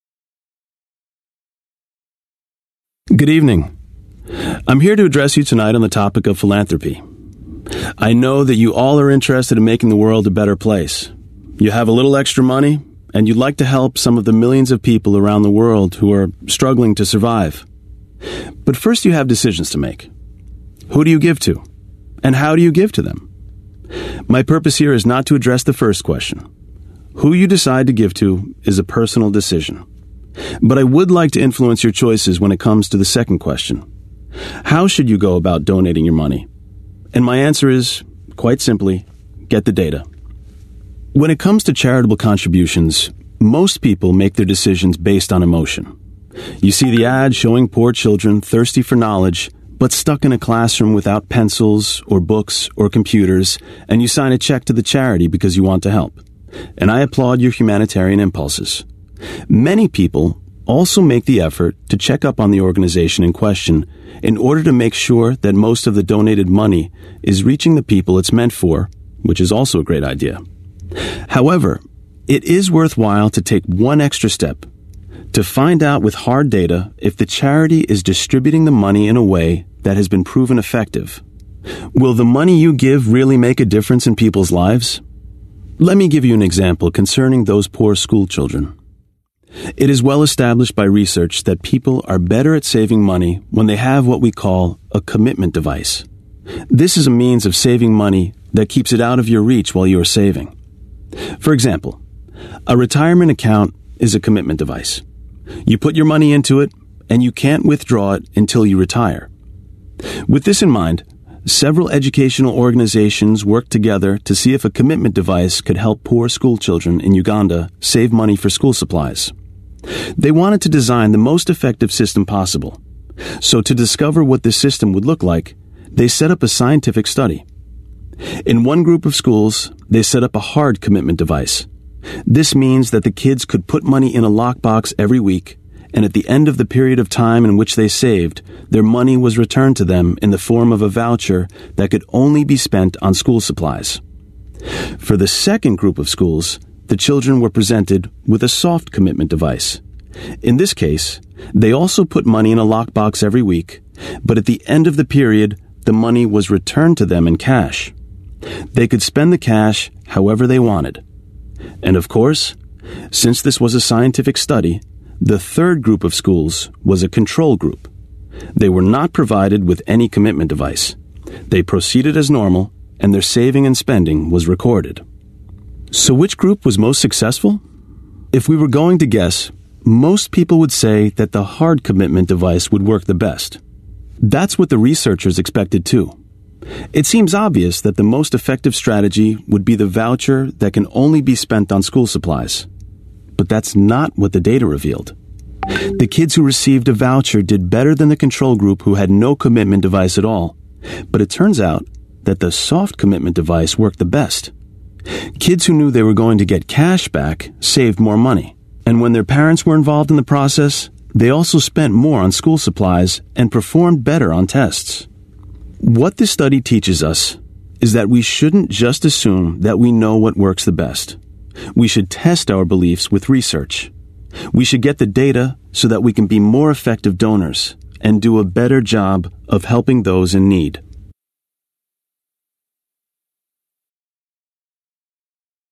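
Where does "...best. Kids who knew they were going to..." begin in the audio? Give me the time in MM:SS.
03:24.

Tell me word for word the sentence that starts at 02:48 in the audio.
They were not provided with any commitment device.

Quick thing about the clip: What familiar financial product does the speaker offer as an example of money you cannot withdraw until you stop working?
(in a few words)
retirement account.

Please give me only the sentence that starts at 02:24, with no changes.
For the second group of schools, the children were presented with a soft commitment device.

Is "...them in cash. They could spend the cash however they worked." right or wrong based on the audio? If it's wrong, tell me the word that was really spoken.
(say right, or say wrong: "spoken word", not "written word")
wrong: "wanted", not "worked".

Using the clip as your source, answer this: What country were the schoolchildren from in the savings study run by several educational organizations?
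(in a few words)
Uganda.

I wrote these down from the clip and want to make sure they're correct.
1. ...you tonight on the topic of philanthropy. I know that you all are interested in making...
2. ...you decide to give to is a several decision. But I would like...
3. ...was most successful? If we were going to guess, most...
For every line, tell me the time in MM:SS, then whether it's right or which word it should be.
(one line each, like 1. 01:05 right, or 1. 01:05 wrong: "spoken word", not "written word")
1. 00:05 right
2. 00:27 wrong: "personal", not "several"
3. 02:56 right.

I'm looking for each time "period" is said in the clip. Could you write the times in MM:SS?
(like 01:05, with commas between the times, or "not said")
02:16, 02:35.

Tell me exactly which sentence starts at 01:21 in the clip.
Will the money you give really make a difference in people's lives?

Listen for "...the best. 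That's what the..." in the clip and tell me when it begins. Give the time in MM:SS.
03:03.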